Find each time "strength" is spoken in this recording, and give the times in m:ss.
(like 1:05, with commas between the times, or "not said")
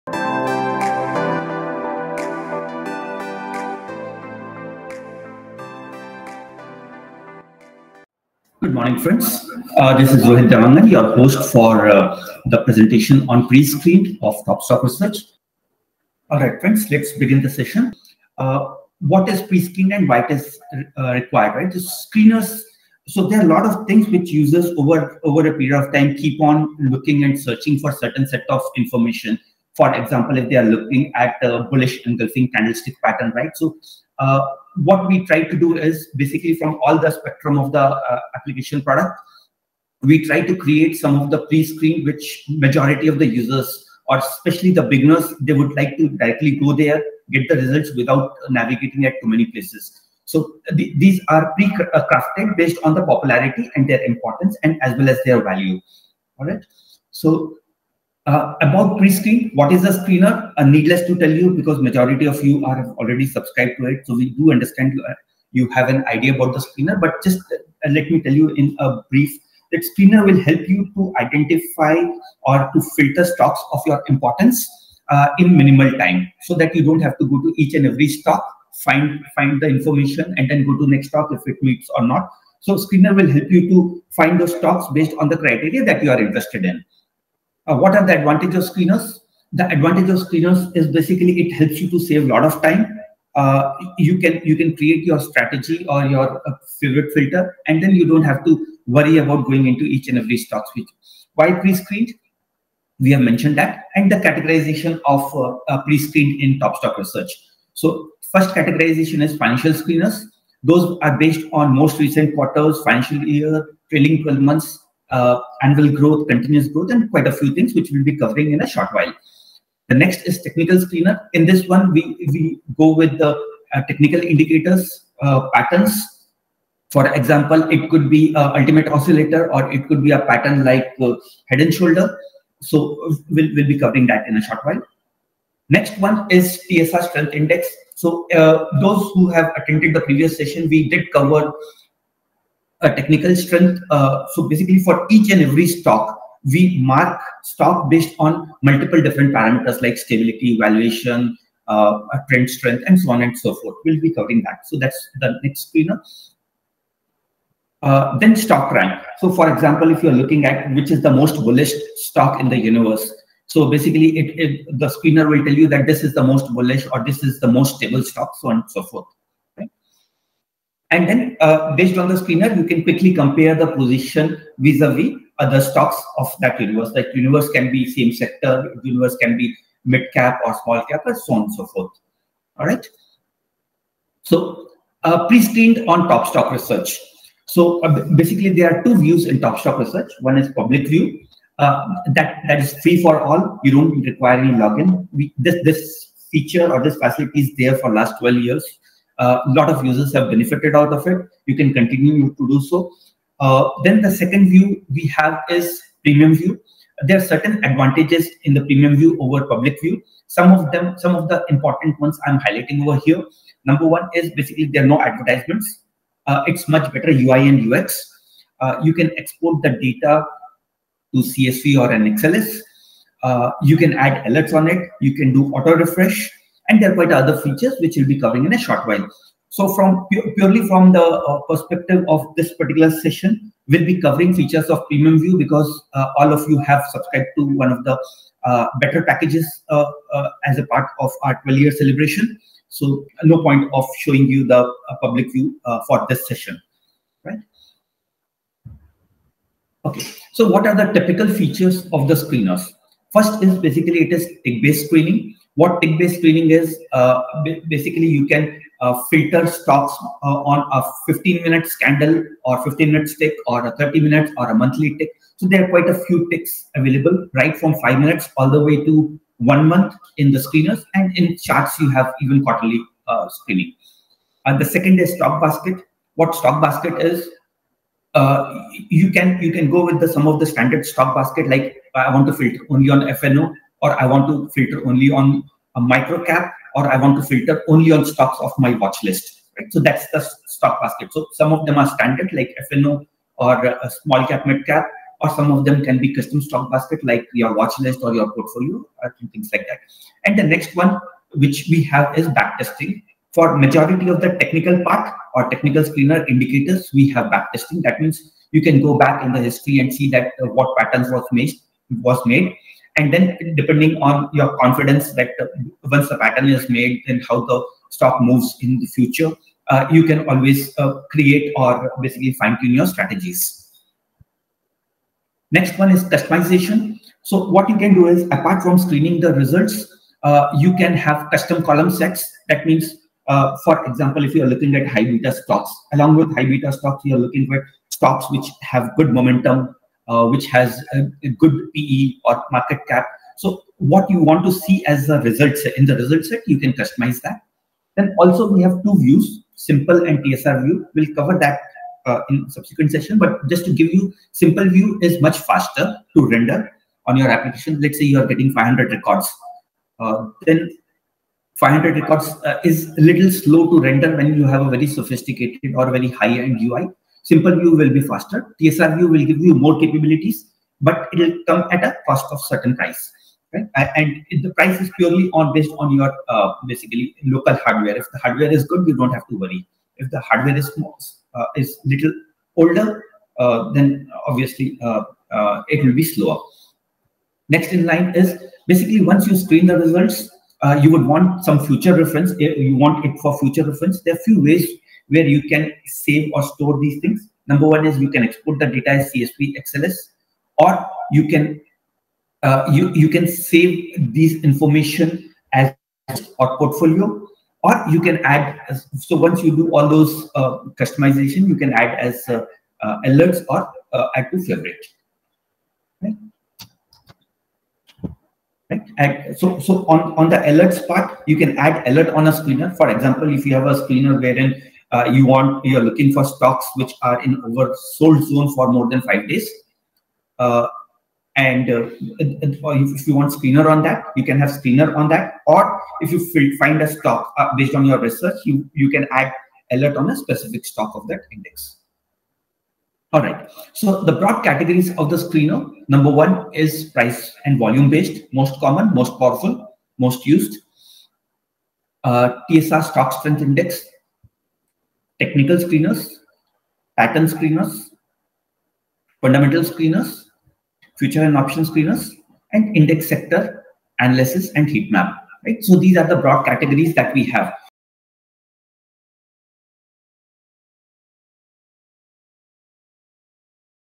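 2:17, 2:23, 2:32, 7:33.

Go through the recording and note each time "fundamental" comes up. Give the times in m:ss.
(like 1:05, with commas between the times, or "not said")
7:39.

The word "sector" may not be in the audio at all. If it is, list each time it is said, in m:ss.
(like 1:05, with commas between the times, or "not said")
2:58, 7:43.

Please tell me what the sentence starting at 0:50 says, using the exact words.
So th these are pre-crafted uh, based on the popularity and their importance and as well as their value.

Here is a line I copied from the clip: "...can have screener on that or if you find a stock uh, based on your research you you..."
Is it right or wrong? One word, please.
right.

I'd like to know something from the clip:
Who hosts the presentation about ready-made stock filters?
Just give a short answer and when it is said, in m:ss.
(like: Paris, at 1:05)
Rohit Devangan, at 0:10.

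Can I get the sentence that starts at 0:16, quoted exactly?
All right, friends, let's begin the session.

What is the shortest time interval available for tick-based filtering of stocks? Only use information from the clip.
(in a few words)
five minutes.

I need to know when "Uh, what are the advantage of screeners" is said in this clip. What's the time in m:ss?
1:27.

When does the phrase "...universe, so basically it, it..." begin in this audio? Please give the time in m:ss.
2:42.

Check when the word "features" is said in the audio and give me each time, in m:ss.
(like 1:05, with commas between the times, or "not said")
3:16, 3:47, 3:54, 4:11.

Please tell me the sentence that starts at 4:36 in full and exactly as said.
What stock basket is, uh, you can you can go with the some of the standard stock basket.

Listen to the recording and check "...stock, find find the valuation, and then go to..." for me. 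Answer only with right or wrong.
wrong.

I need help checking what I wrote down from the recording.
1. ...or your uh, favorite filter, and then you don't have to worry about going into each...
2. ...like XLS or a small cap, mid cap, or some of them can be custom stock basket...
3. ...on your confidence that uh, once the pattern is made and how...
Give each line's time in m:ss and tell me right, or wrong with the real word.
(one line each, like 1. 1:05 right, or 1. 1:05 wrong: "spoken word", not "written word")
1. 1:35 right
2. 4:52 wrong: "FNO", not "XLS"
3. 5:14 right.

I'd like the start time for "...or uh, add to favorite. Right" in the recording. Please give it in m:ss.
6:53.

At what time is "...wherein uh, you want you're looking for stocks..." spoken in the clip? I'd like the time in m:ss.
7:04.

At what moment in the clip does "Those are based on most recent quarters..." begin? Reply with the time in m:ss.
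1:50.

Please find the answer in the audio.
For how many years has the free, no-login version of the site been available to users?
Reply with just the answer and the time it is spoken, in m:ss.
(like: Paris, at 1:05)
12, at 3:18.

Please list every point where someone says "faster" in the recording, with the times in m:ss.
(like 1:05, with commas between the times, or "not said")
5:55, 6:08.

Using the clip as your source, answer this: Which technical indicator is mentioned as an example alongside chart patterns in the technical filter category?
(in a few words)
ultimate oscillator.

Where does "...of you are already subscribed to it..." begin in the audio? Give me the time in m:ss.
1:02.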